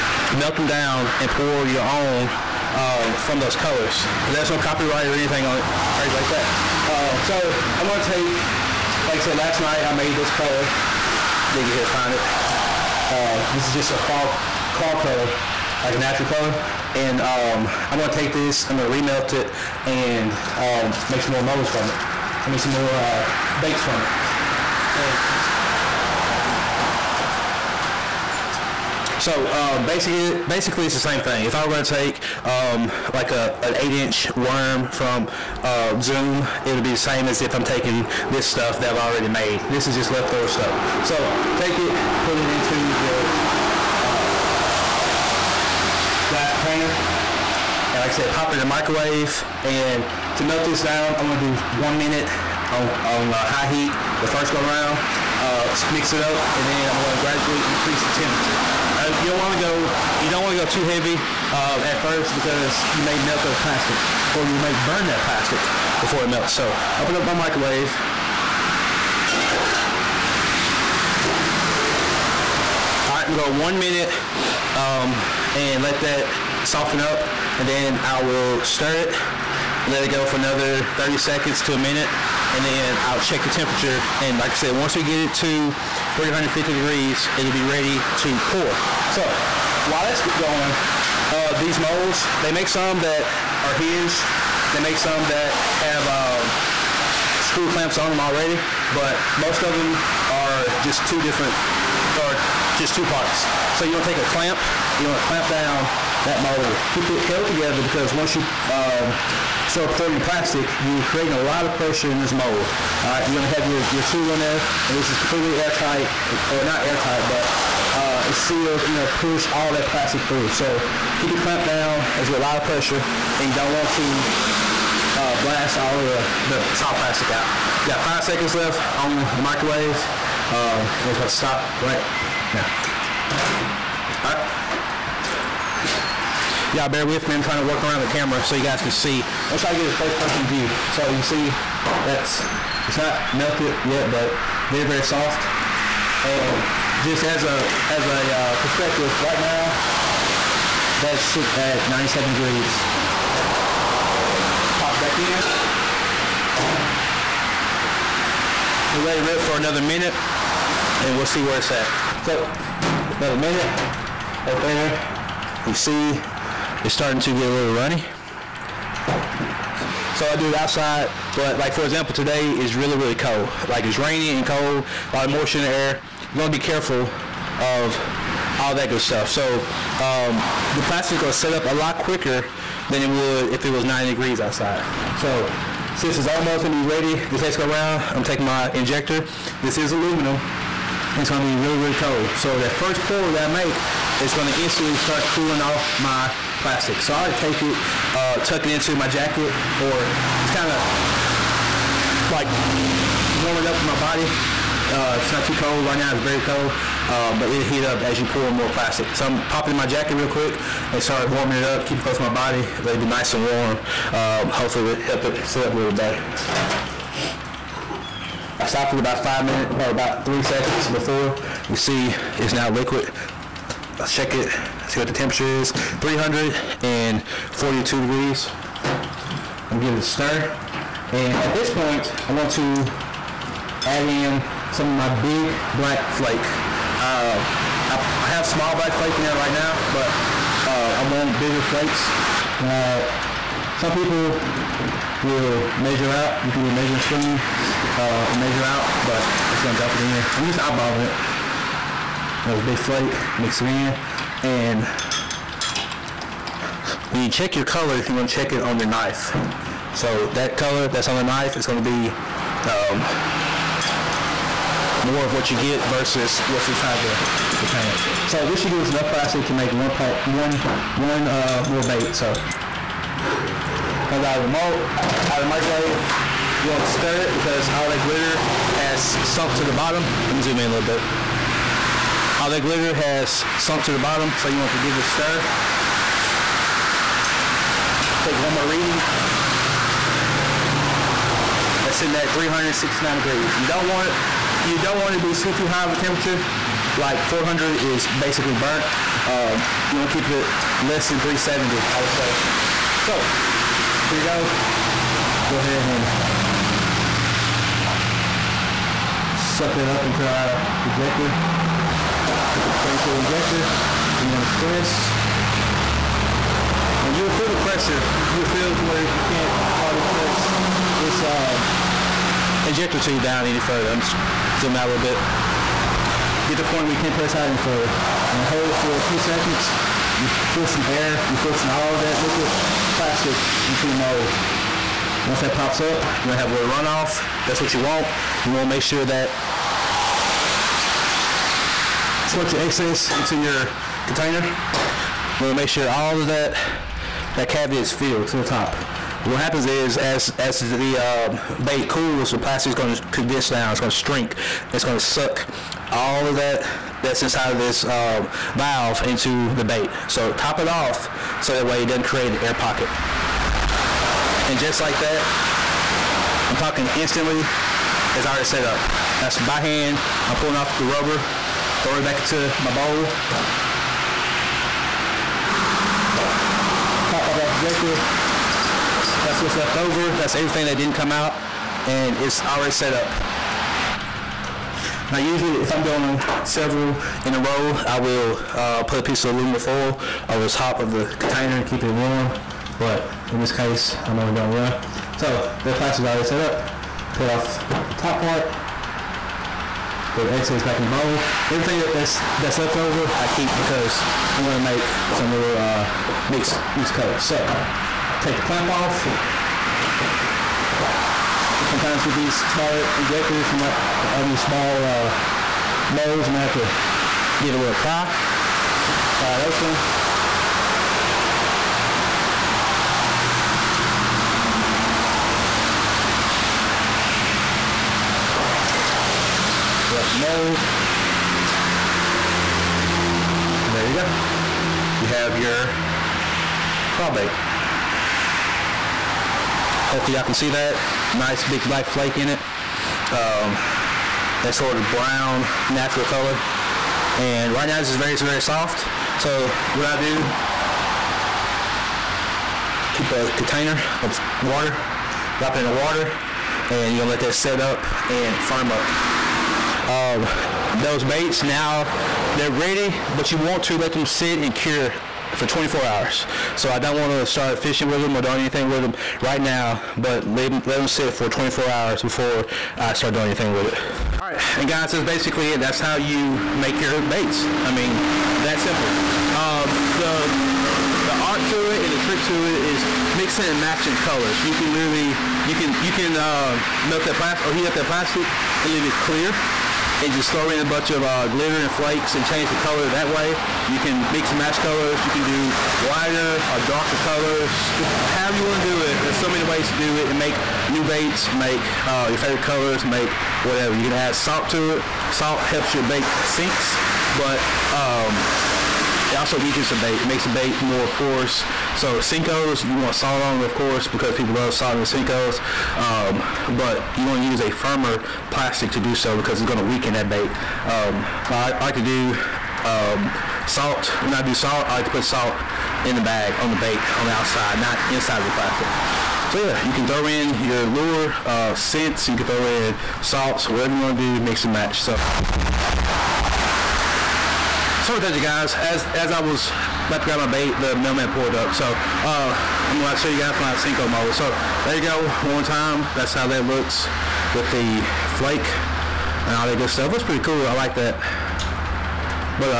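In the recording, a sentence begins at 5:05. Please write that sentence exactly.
Go ahead and suck that up into our ejector the injector.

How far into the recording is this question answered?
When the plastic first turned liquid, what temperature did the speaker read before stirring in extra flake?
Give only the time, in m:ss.
3:46.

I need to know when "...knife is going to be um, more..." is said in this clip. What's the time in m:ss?
4:21.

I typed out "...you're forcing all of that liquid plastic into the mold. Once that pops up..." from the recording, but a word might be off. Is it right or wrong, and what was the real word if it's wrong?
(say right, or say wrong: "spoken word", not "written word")
right.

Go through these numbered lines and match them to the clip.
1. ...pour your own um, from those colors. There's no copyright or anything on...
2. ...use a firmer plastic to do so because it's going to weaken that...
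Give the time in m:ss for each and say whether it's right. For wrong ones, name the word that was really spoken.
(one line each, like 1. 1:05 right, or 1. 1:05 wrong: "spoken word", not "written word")
1. 0:01 right
2. 8:37 right.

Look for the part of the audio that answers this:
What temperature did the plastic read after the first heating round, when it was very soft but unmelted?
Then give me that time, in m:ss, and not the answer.
2:31.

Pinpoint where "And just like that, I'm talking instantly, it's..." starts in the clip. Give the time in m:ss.
6:04.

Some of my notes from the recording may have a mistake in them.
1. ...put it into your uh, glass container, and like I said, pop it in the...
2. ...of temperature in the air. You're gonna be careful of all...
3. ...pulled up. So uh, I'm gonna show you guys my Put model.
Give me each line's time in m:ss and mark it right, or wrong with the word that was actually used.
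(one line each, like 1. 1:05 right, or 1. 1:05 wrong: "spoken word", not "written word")
1. 0:42 right
2. 2:55 wrong: "moisture", not "temperature"
3. 9:01 wrong: "Senko", not "Put".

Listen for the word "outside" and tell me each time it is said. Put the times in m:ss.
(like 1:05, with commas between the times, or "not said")
2:50, 3:04, 8:47.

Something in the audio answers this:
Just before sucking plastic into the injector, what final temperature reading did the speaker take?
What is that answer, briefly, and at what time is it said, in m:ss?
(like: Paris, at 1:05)
369 degrees, at 4:52.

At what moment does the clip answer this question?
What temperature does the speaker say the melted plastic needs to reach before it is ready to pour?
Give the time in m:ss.
1:26.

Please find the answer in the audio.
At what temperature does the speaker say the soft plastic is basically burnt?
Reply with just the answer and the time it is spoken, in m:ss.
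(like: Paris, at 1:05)
400, at 4:57.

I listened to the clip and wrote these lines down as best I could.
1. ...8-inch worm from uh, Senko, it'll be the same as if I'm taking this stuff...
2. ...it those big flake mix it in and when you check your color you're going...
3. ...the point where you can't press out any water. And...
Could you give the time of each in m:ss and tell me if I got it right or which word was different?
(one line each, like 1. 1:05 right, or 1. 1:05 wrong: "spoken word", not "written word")
1. 0:33 wrong: "Zoom", not "Senko"
2. 4:11 right
3. 5:26 wrong: "further", not "water".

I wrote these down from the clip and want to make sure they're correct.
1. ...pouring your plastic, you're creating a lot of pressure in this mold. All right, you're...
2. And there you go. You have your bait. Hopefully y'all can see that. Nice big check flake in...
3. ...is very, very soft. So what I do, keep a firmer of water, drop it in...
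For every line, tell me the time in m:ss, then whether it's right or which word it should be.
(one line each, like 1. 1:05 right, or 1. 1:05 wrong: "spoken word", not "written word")
1. 1:49 right
2. 7:13 wrong: "black", not "check"
3. 7:27 wrong: "container", not "firmer".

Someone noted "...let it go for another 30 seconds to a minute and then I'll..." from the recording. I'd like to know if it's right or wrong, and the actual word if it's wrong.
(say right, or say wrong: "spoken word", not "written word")
right.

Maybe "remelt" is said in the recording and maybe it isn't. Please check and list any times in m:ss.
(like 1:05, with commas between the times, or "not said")
0:18.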